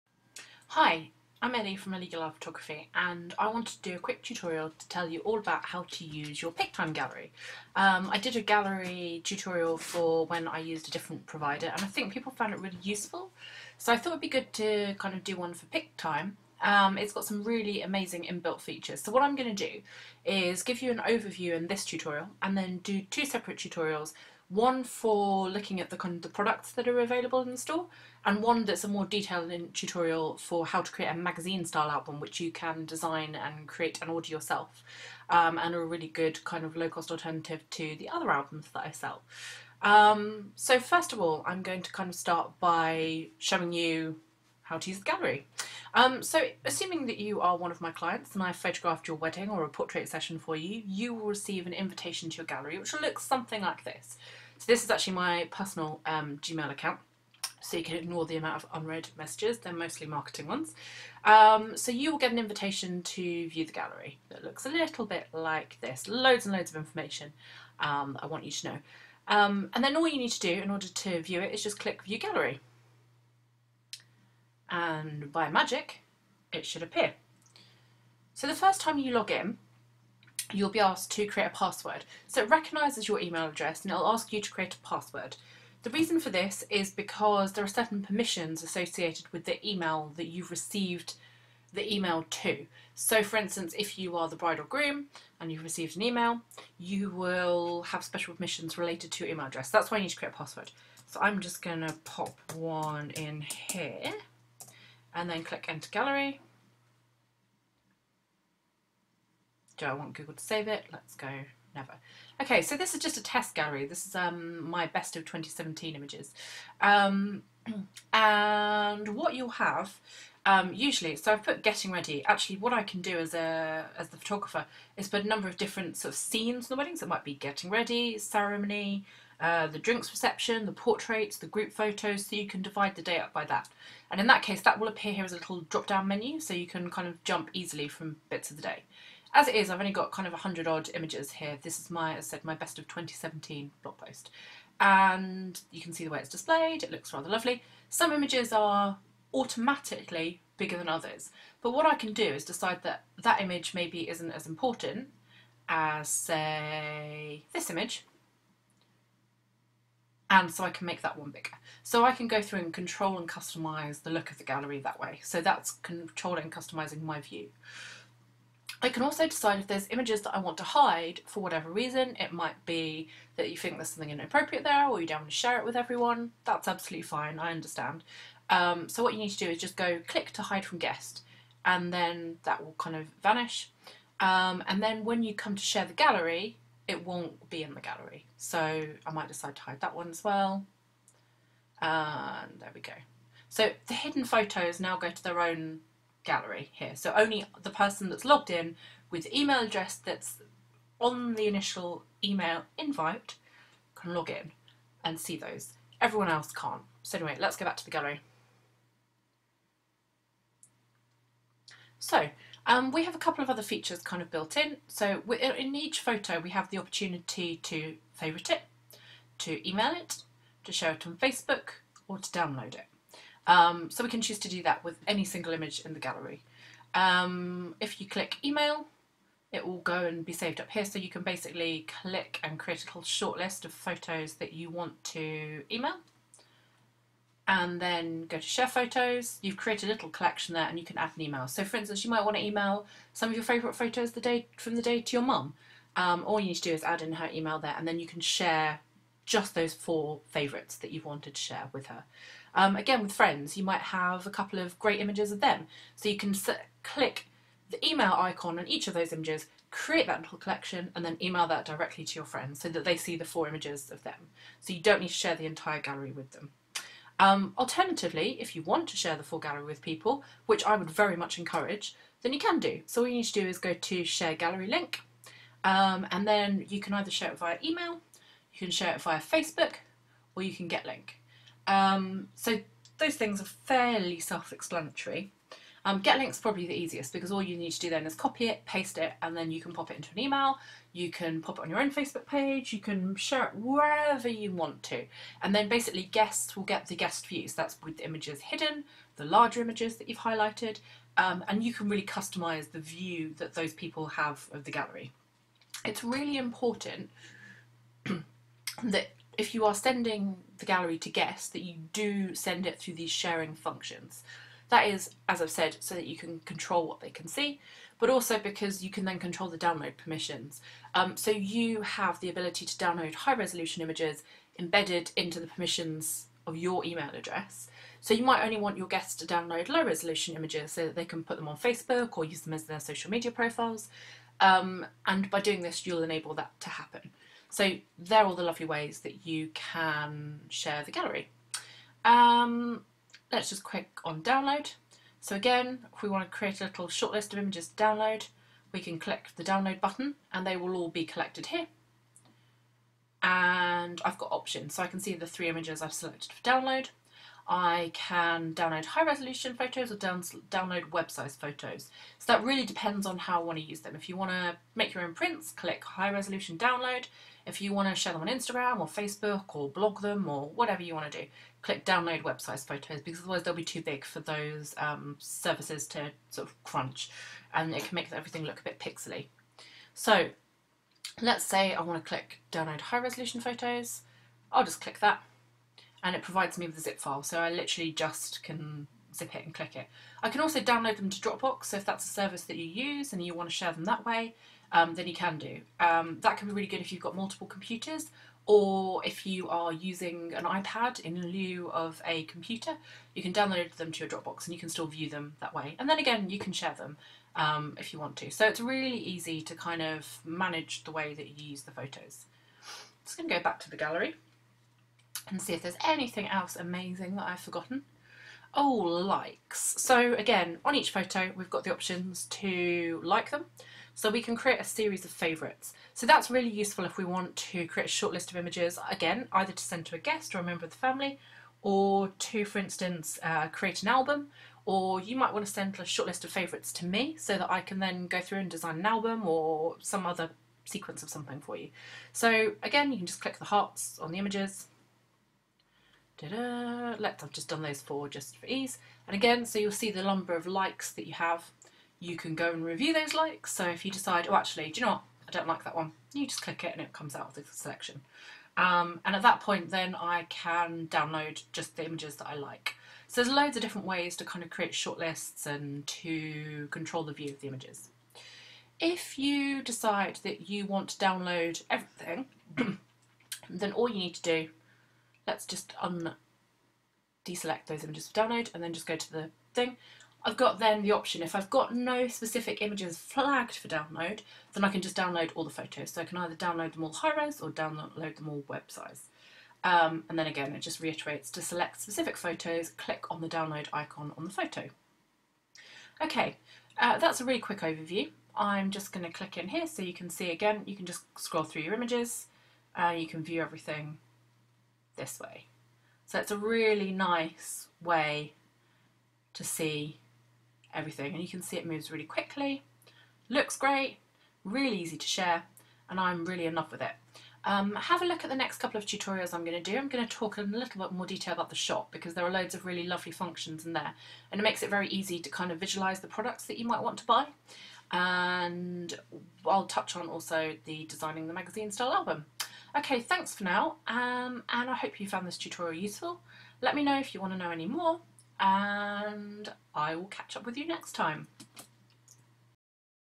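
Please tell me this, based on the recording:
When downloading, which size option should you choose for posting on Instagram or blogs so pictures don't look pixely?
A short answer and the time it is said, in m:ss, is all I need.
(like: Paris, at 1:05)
Web sized photos, at 6:12.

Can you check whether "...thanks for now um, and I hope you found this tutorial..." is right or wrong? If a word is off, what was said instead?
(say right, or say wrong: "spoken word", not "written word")
right.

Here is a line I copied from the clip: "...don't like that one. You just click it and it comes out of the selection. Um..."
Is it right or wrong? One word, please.
right.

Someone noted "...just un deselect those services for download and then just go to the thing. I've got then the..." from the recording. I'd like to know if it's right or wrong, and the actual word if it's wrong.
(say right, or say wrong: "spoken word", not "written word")
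wrong: "images", not "services".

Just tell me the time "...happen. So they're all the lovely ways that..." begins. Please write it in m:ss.
5:36.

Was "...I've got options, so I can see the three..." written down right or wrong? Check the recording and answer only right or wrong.
right.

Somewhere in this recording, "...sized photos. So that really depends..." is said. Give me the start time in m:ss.
6:01.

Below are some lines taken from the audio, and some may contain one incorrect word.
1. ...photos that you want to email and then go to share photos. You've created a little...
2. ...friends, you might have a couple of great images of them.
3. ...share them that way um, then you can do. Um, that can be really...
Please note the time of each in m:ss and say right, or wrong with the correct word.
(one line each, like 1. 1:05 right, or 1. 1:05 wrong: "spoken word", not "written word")
1. 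3:53 right
2. 4:13 right
3. 6:33 right.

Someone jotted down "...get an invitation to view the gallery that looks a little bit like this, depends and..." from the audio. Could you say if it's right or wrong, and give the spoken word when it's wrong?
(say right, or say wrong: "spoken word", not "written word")
wrong: "loads", not "depends".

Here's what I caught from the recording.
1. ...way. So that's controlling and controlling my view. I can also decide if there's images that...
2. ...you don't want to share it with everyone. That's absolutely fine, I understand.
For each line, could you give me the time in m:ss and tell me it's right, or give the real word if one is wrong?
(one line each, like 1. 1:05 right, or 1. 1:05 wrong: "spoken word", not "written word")
1. 2:44 wrong: "customising", not "controlling"
2. 2:55 right.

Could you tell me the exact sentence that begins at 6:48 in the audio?
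So it's really easy to kind of manage the way that you use the photos.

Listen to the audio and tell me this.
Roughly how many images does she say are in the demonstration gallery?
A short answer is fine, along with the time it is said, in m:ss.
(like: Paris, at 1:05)
100, at 2:20.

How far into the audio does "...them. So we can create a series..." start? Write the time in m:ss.
7:03.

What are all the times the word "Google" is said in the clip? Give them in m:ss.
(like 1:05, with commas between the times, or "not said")
1:50.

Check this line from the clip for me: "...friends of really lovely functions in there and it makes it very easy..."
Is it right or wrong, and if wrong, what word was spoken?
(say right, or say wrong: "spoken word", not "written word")
wrong: "loads", not "friends".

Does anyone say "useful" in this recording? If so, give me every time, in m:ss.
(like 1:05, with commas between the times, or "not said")
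0:12, 7:06, 8:55.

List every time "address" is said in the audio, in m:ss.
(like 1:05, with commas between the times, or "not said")
1:23, 1:39, 3:19, 5:27.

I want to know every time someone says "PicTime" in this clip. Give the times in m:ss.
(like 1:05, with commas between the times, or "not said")
0:06, 0:15.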